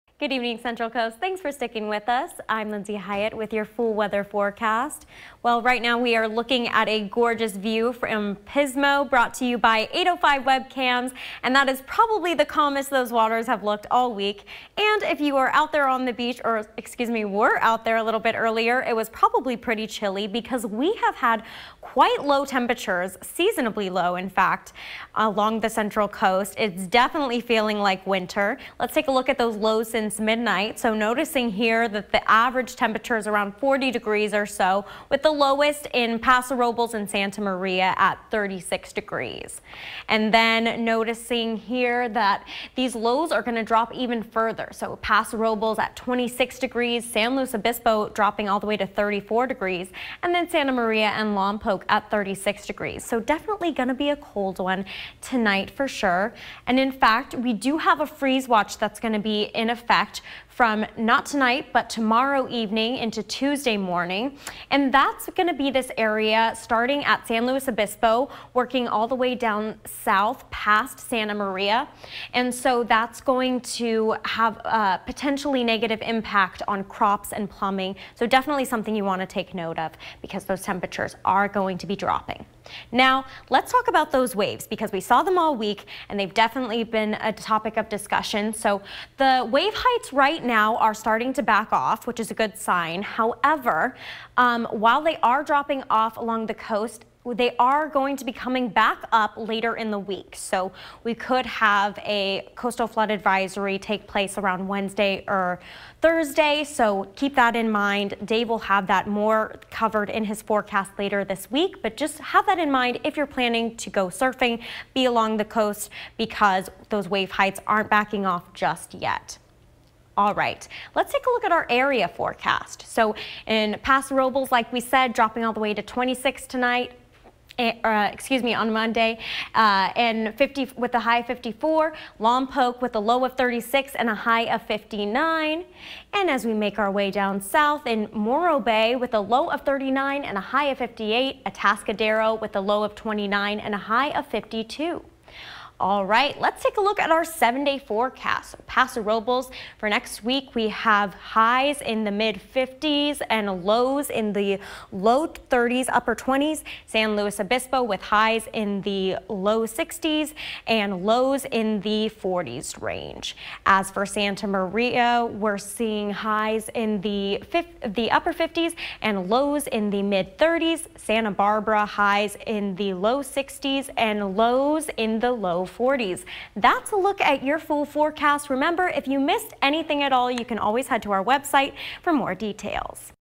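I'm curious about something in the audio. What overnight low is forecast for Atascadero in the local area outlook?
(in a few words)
29.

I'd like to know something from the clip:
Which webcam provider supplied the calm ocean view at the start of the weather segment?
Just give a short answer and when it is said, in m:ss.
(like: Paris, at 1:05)
805 webcams, at 0:09.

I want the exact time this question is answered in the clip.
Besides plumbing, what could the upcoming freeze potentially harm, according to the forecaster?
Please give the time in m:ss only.
1:16.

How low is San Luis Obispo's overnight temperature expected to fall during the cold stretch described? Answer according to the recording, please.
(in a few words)
34 degrees.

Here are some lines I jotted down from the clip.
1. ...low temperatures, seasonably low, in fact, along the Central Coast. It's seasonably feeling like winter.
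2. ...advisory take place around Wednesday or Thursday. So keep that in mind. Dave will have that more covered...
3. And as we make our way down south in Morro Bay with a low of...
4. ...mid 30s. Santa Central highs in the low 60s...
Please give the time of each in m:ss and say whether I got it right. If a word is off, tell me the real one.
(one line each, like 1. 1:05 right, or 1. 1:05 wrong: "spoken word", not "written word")
1. 0:22 wrong: "definitely", not "seasonably"
2. 1:43 right
3. 2:16 right
4. 2:50 wrong: "Barbara", not "Central".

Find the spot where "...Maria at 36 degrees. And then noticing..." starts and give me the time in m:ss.
0:37.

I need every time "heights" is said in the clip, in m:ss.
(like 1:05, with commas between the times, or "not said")
1:29, 1:57.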